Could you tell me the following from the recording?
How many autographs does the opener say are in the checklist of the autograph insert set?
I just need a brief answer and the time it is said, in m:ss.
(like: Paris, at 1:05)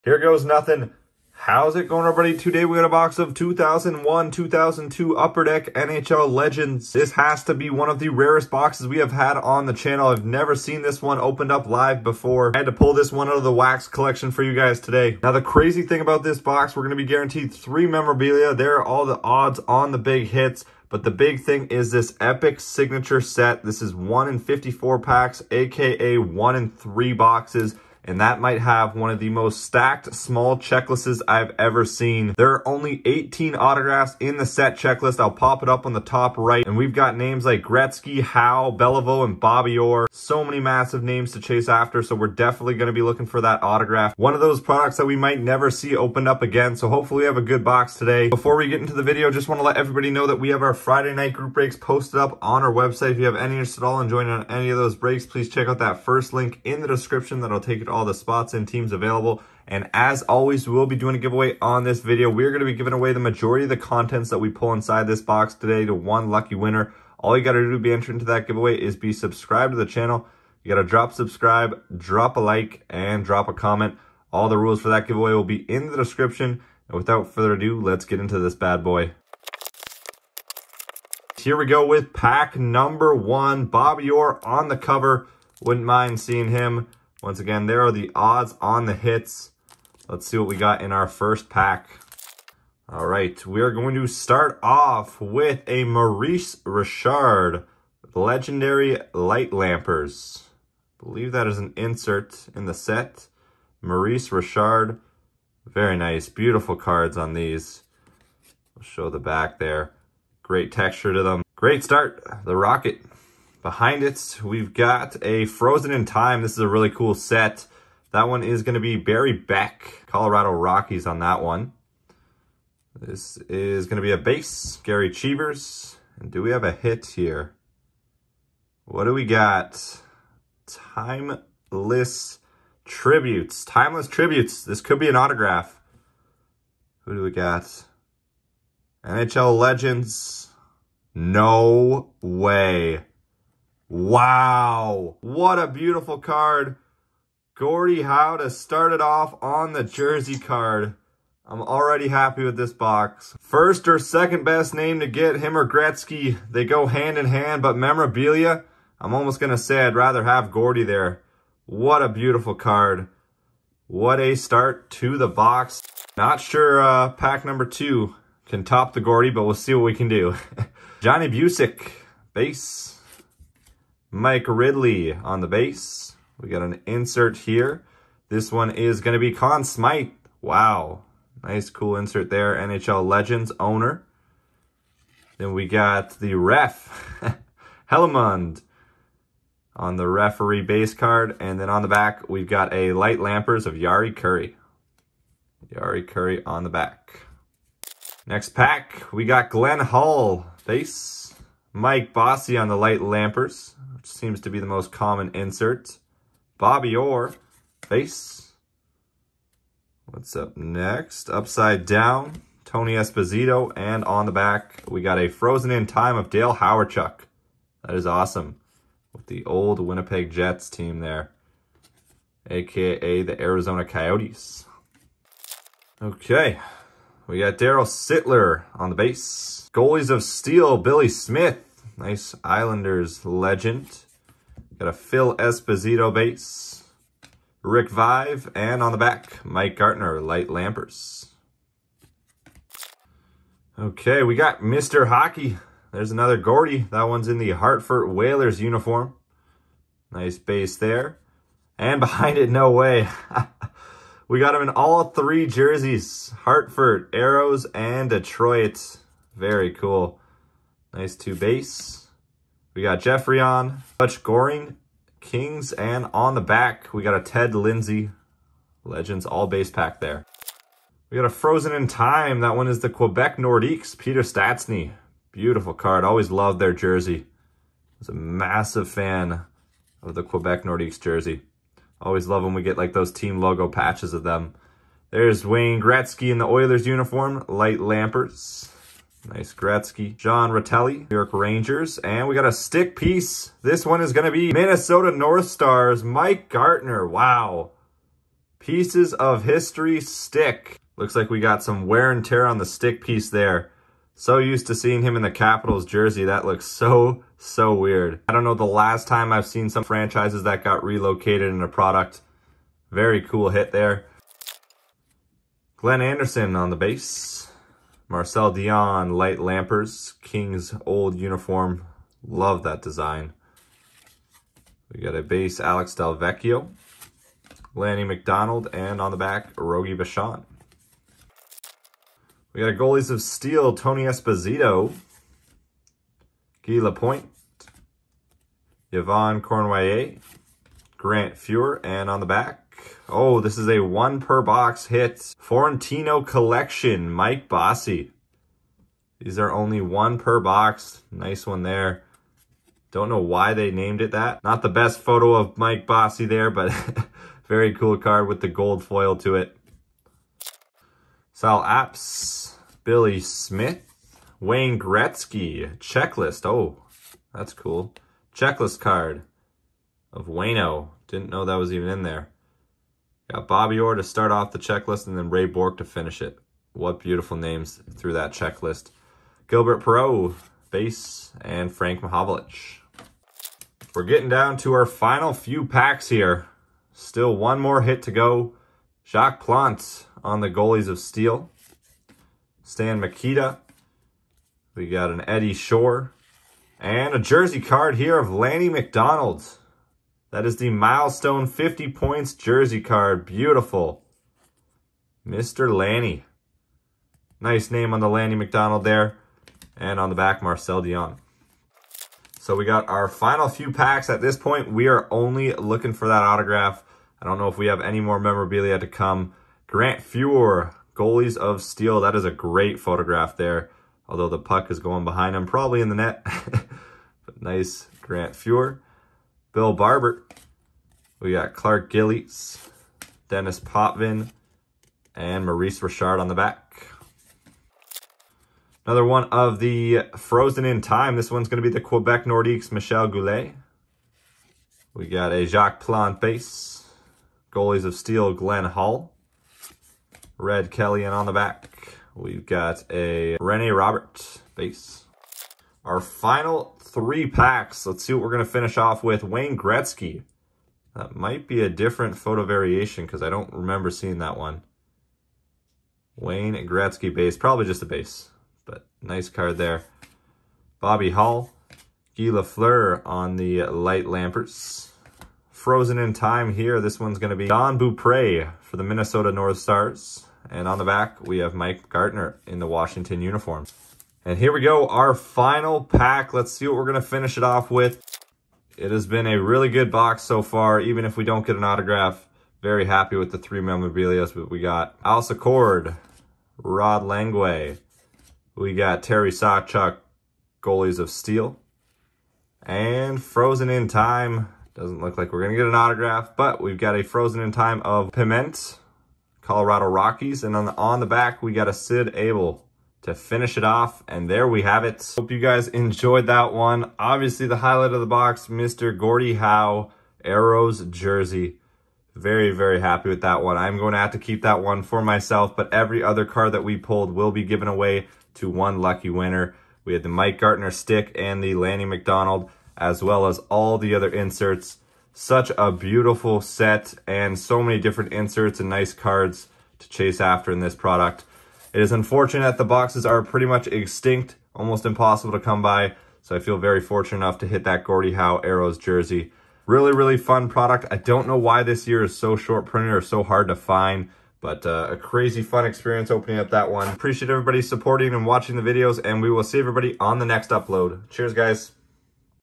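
18, at 0:33.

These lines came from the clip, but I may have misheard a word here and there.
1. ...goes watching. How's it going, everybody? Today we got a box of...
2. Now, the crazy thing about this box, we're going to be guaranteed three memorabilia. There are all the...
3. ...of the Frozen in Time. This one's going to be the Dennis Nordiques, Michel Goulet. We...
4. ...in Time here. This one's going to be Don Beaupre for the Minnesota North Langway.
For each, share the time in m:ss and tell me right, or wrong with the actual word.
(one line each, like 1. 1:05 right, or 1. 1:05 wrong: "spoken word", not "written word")
1. 0:00 wrong: "nothing", not "watching"
2. 0:15 right
3. 7:19 wrong: "Quebec", not "Dennis"
4. 7:55 wrong: "Stars", not "Langway".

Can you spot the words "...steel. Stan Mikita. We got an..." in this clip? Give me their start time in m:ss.
6:30.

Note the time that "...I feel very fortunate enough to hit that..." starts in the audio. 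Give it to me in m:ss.
9:06.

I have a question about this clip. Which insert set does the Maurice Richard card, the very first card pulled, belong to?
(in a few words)
Legendary Light Lampers.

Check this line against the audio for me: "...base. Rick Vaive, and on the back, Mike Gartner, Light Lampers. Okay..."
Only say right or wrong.
right.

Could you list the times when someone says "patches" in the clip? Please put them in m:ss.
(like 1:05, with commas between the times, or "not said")
4:43.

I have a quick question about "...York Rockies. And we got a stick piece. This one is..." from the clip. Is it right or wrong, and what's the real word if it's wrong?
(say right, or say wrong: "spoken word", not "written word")
wrong: "Rangers", not "Rockies".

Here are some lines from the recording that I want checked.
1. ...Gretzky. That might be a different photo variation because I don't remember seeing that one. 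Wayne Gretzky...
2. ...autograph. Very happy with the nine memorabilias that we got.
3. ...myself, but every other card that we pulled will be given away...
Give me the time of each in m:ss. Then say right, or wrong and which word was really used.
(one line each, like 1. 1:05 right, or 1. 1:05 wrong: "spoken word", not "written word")
1. 7:39 right
2. 8:11 wrong: "three", not "nine"
3. 8:45 right.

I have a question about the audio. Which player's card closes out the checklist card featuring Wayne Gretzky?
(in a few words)
Ray Bourque.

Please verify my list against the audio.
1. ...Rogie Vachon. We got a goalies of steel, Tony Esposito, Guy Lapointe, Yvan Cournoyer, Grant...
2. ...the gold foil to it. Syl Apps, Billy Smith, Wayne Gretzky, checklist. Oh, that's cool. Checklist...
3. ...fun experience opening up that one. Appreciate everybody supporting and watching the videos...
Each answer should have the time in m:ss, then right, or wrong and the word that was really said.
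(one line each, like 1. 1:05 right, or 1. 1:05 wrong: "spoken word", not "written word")
1. 5:29 right
2. 5:58 right
3. 9:15 right.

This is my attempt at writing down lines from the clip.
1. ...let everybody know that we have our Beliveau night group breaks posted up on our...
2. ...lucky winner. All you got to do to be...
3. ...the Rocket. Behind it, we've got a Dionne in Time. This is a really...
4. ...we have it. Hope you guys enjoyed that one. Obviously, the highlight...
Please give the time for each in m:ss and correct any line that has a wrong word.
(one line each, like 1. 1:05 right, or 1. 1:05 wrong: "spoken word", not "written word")
1. 0:49 wrong: "Friday", not "Beliveau"
2. 1:06 right
3. 1:52 wrong: "Frozen", not "Dionne"
4. 8:34 right.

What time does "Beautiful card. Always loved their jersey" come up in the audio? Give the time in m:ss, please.
4:35.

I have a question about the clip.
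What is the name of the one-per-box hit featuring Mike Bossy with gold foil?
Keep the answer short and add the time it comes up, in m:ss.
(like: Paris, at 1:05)
Florentine Collection, at 5:45.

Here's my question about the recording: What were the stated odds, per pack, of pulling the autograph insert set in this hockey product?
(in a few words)
1 in 54.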